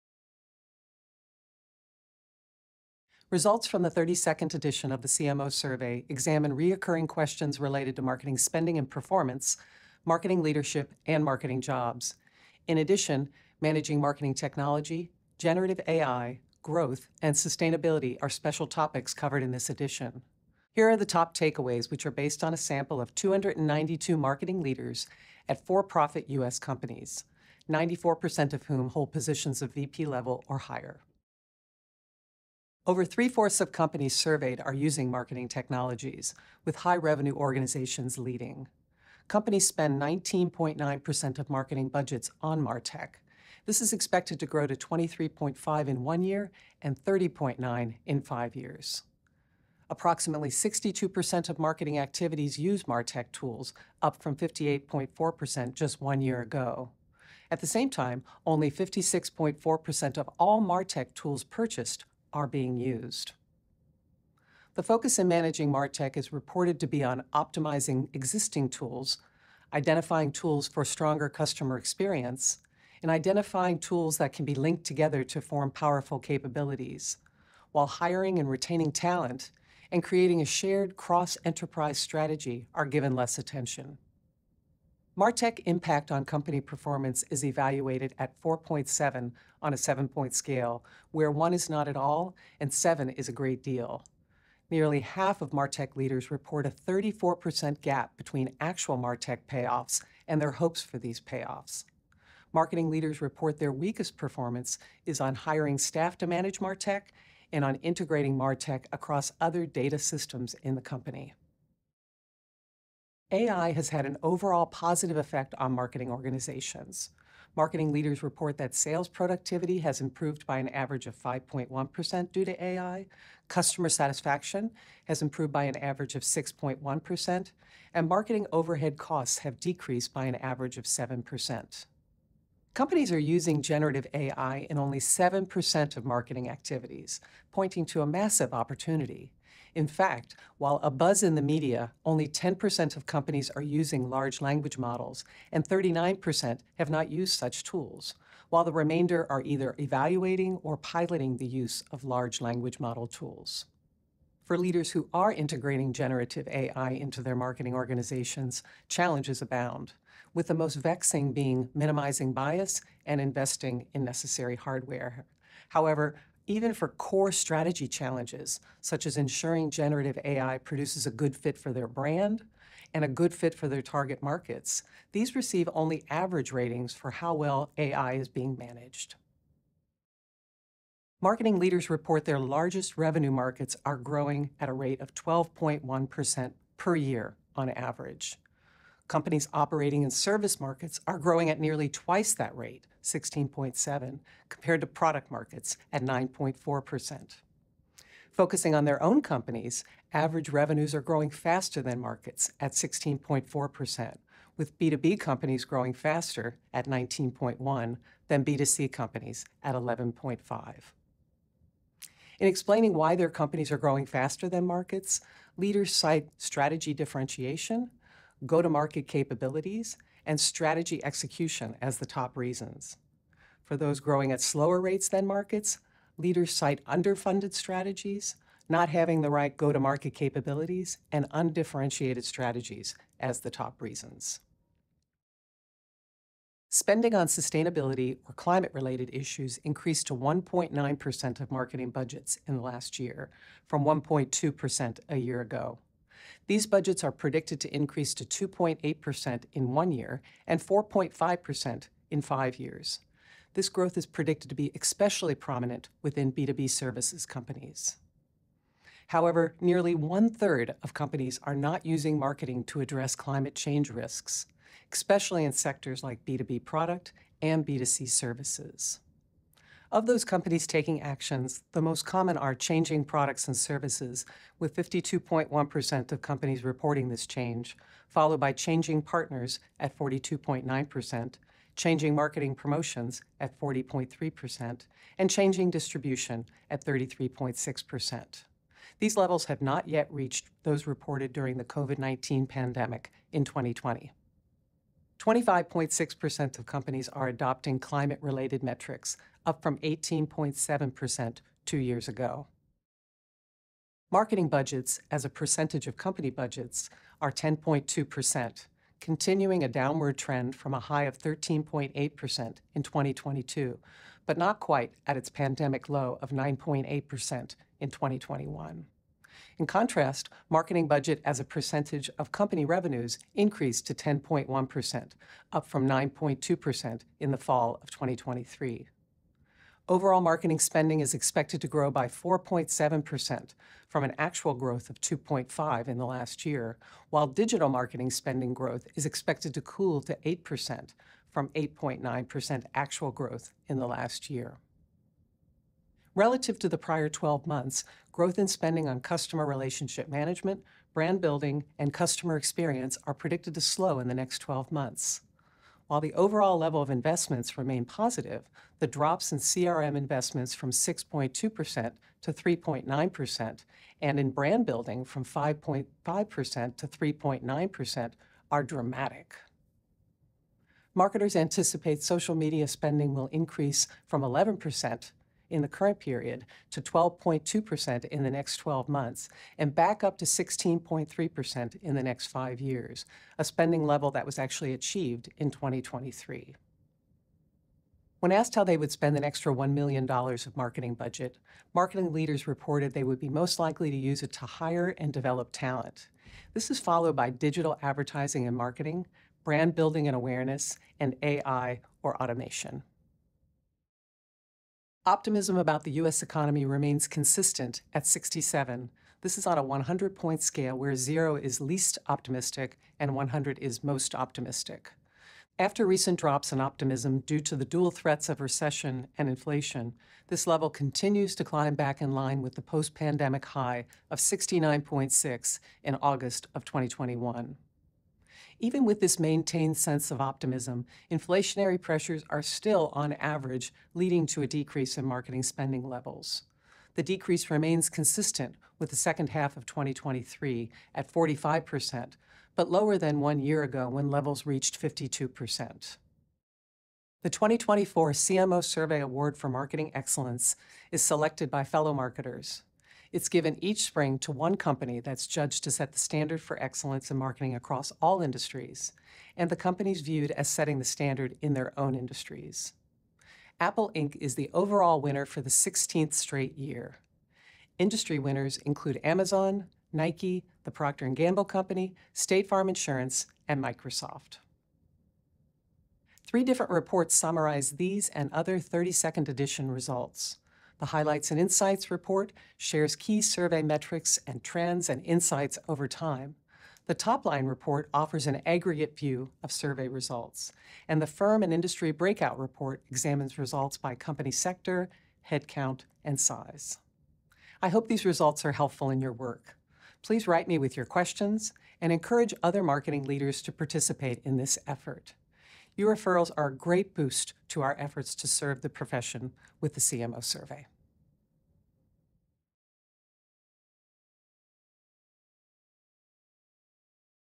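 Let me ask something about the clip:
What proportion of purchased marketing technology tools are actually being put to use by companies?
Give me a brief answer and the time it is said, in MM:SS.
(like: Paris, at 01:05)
56.4%, at 00:58.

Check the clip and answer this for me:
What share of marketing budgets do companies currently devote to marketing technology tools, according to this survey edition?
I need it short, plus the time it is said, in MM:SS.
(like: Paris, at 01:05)
19.9%, at 00:40.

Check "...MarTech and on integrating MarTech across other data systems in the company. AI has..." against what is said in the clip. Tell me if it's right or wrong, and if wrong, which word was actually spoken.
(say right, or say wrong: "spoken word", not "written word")
right.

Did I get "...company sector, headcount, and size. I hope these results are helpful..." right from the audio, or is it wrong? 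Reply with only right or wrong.
right.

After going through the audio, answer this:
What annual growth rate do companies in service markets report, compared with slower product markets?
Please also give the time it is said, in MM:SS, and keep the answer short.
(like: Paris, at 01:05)
16.7, at 03:13.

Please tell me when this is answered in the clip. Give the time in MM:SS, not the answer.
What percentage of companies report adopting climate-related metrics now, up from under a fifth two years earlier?
04:55.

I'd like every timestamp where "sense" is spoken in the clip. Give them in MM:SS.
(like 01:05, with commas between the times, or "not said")
07:09.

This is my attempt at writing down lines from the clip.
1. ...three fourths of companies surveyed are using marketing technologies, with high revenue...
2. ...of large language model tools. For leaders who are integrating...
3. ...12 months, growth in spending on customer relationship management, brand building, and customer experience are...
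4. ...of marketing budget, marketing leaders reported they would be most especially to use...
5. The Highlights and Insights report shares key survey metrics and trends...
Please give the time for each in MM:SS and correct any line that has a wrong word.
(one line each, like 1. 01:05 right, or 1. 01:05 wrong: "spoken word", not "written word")
1. 00:33 right
2. 02:31 right
3. 05:47 right
4. 06:30 wrong: "likely", not "especially"
5. 08:00 right.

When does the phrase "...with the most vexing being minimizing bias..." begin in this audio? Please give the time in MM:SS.
02:40.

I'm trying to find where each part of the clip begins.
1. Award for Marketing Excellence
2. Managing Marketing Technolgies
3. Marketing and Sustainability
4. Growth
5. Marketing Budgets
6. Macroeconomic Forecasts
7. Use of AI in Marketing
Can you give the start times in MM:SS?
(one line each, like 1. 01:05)
1. 07:26
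2. 00:31
3. 03:55
4. 03:00
5. 05:03
6. 06:44
7. 01:52.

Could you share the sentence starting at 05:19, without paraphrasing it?
In contrast, marketing budget as a percentage of company revenues increased to 10.1%, up from 9.2% in the fall of 2023.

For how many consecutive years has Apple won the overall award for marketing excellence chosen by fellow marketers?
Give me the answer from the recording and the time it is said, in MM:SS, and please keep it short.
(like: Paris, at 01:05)
16, at 07:45.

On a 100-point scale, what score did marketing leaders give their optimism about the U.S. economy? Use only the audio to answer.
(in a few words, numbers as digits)
67.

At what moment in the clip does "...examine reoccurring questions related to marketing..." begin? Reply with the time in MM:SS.
00:06.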